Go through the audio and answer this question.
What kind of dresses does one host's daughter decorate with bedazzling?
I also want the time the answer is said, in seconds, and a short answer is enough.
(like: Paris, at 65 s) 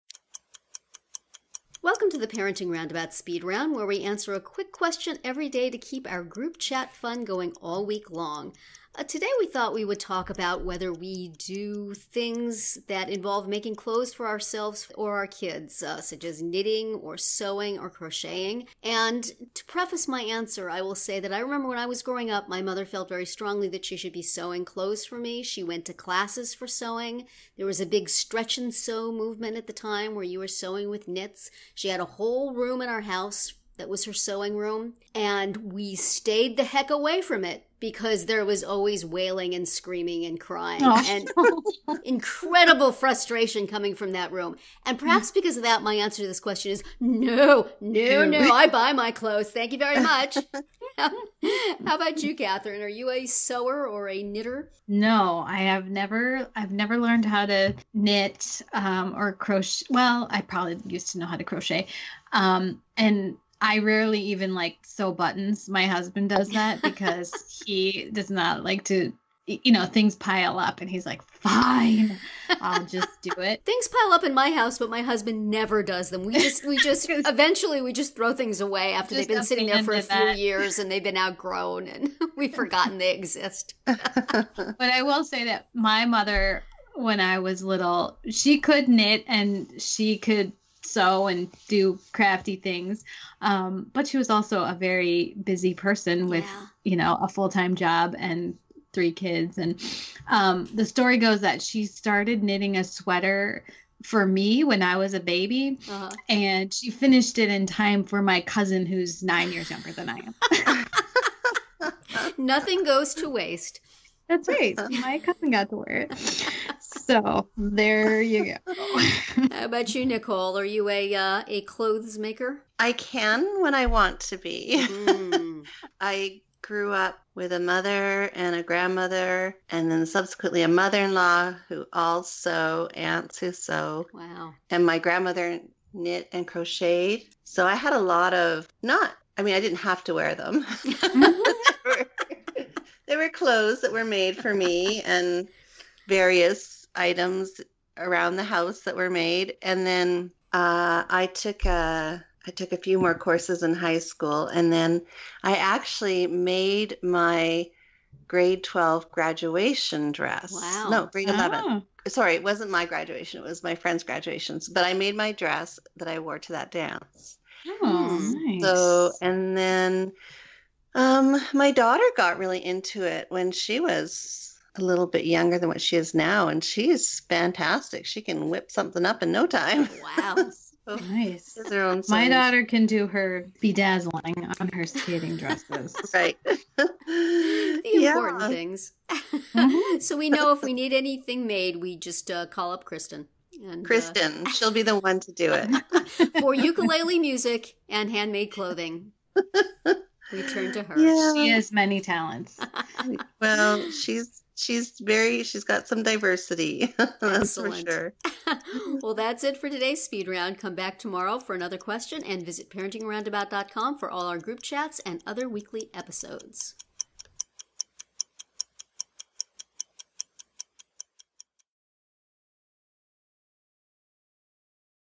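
Skating dresses, at 184 s.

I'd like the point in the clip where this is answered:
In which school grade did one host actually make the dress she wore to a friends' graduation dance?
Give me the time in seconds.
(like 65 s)
161 s.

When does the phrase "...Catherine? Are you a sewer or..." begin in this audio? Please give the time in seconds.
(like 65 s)
52 s.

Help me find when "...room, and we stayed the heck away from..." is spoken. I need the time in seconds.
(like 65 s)
34 s.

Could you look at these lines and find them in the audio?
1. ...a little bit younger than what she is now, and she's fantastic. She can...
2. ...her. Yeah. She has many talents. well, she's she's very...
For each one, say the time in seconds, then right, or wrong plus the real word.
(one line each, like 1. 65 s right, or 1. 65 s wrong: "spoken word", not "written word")
1. 174 s right
2. 200 s right.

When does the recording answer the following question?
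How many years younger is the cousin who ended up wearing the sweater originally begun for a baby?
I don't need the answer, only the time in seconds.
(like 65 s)
109 s.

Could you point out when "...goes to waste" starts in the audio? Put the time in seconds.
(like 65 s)
112 s.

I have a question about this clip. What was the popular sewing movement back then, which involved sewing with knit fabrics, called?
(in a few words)
Stretch and sew.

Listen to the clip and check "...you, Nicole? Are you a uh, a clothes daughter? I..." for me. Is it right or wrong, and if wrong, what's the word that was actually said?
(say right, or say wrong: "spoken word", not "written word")
wrong: "maker", not "daughter".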